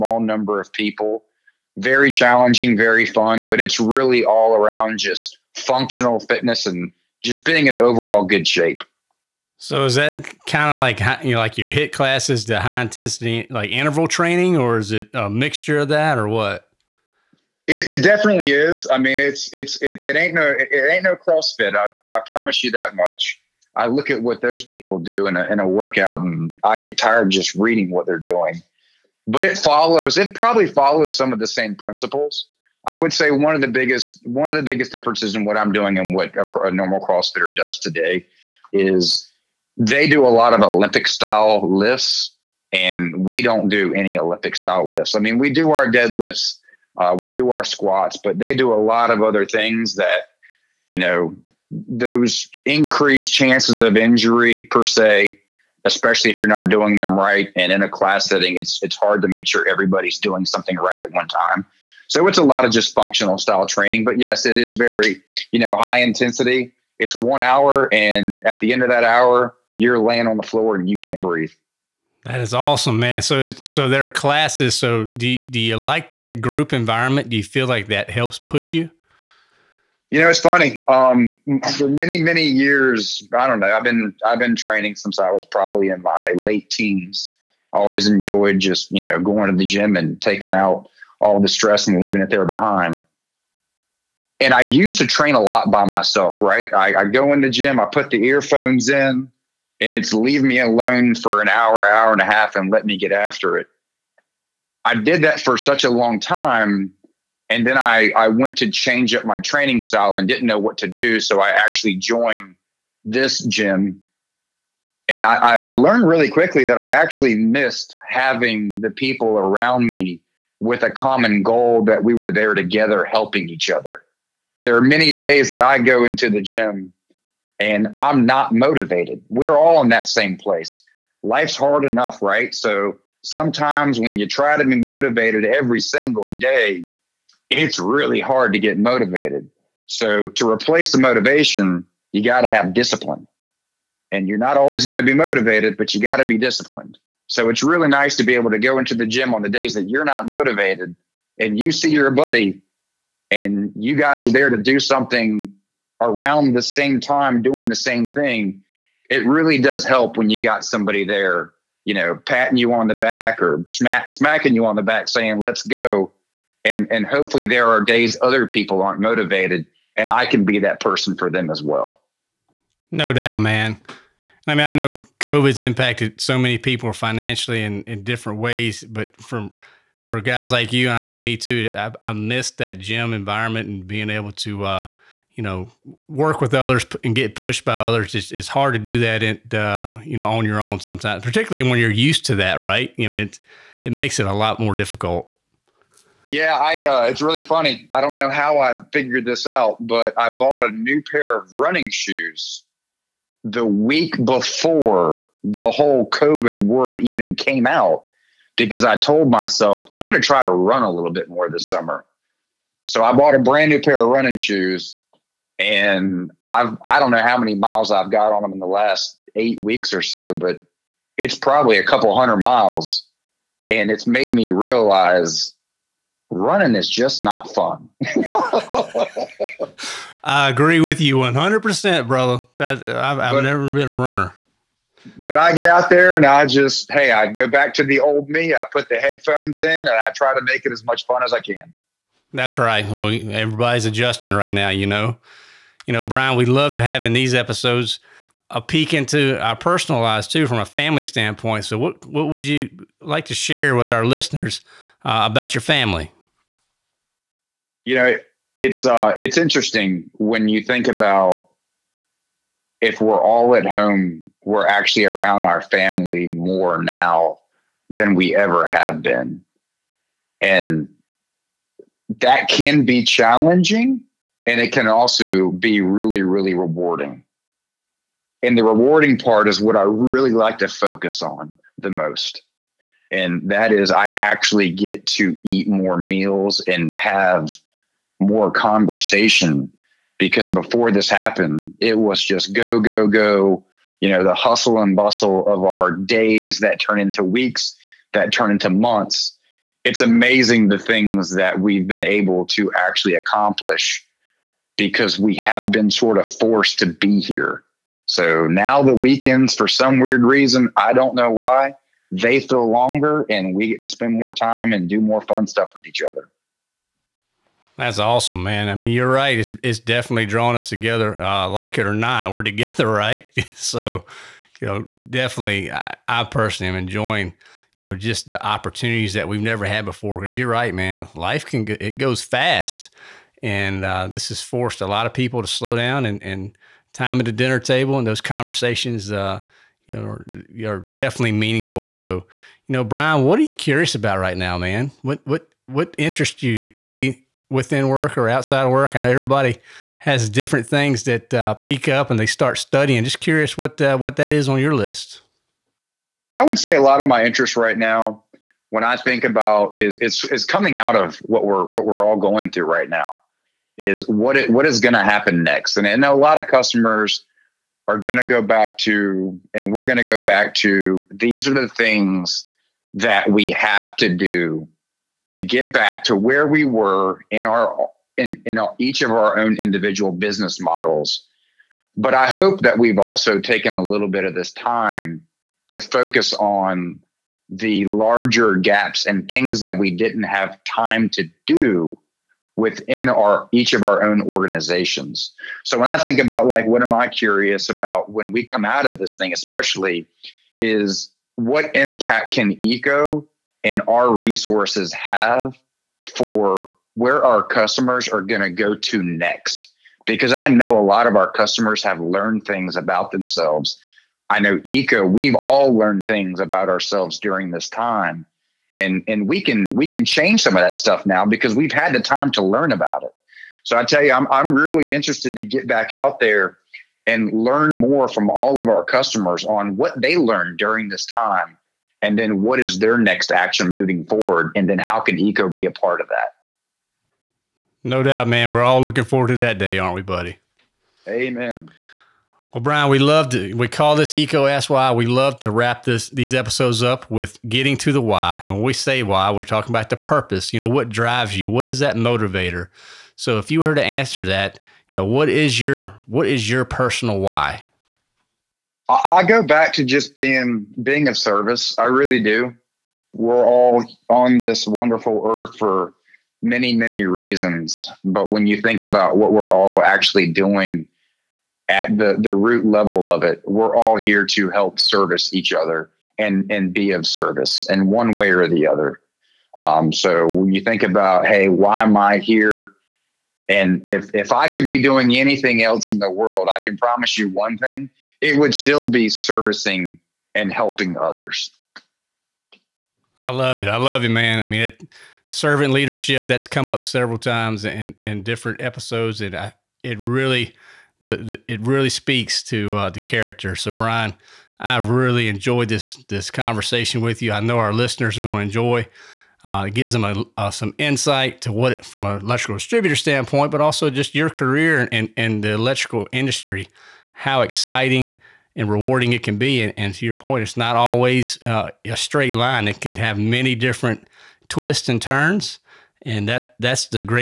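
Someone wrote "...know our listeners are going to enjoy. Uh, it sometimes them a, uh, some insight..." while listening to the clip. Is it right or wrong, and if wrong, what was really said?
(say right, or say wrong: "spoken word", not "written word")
wrong: "gives", not "sometimes".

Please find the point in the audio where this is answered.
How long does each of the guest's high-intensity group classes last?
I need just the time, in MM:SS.
01:07.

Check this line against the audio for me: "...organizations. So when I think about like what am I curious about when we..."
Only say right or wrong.
right.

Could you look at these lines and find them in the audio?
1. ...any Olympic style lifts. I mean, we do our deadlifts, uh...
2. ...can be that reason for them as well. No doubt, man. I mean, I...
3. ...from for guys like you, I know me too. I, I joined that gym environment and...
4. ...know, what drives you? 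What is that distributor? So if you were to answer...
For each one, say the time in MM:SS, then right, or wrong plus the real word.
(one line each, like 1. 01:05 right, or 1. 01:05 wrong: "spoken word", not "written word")
1. 00:43 right
2. 02:50 wrong: "person", not "reason"
3. 02:59 wrong: "missed", not "joined"
4. 07:30 wrong: "motivator", not "distributor".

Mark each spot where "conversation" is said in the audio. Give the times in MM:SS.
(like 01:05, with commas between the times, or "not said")
04:48, 05:38, 08:26.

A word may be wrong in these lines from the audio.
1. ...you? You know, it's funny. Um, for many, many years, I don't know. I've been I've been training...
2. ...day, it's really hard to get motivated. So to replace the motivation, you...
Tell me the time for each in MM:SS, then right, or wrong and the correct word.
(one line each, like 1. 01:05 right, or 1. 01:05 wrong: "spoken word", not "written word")
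1. 01:18 right
2. 02:16 right.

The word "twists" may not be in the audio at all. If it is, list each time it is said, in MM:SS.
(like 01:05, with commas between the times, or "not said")
08:44.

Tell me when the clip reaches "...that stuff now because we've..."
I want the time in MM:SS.
07:00.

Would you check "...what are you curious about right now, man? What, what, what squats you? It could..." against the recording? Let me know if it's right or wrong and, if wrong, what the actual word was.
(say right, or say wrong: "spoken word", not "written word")
wrong: "interests", not "squats".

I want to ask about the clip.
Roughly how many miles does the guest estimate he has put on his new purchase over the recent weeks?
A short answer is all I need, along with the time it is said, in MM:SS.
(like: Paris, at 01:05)
A couple hundred, at 03:41.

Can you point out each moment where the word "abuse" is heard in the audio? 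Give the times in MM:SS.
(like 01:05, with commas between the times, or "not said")
not said.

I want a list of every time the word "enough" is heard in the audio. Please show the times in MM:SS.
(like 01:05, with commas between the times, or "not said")
02:11.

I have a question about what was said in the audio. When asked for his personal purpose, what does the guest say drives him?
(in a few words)
Being of service.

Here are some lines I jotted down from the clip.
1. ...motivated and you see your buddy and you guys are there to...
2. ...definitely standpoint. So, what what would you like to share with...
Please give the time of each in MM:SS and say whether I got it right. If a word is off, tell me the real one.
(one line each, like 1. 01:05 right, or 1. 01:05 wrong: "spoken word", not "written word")
1. 02:30 right
2. 04:10 wrong: "family", not "definitely".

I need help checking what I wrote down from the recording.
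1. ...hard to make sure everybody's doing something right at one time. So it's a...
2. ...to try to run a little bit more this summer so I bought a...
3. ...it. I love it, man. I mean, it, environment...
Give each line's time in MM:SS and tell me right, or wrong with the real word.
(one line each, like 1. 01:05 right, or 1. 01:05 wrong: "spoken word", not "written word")
1. 00:58 right
2. 03:30 right
3. 08:13 wrong: "servant", not "environment".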